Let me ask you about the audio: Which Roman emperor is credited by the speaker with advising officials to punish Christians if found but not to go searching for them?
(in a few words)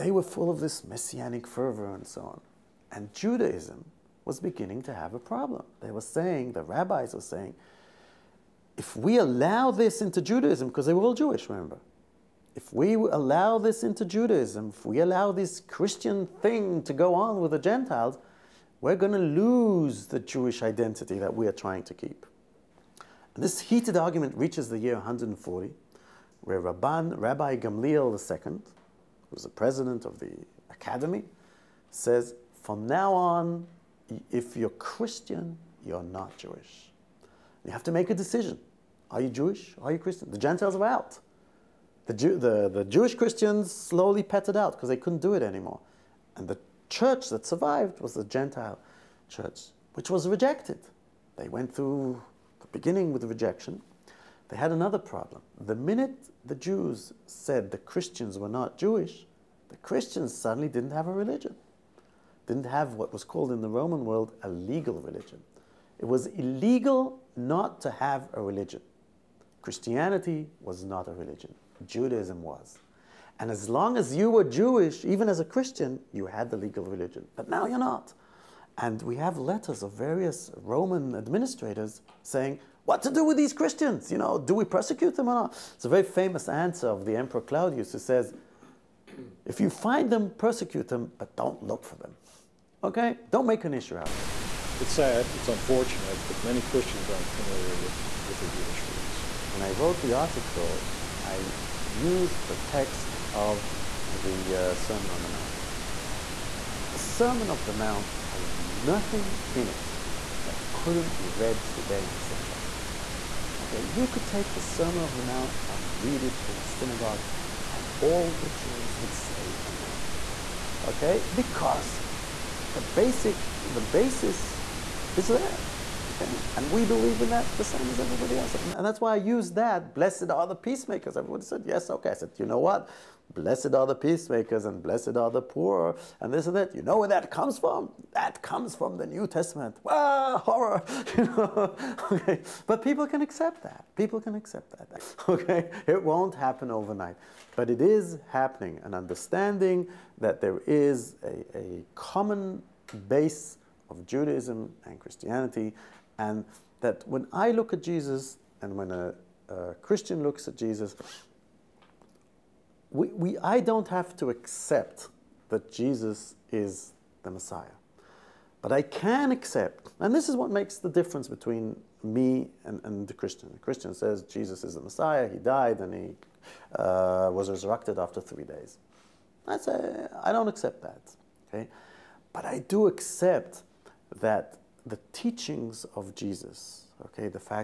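Claudius.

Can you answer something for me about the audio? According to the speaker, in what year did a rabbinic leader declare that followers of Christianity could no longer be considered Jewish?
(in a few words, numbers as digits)
140.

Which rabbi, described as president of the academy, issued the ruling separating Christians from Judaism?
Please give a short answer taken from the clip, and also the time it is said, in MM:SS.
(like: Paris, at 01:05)
Rabbi Gamliel II, at 00:27.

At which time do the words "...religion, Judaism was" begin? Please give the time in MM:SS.
01:11.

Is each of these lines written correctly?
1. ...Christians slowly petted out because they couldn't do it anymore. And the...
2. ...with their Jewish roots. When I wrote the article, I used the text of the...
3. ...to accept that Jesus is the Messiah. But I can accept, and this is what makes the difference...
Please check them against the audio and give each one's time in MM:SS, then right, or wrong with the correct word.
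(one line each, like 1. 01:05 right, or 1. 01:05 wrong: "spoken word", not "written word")
1. 00:43 right
2. 01:38 right
3. 02:44 right.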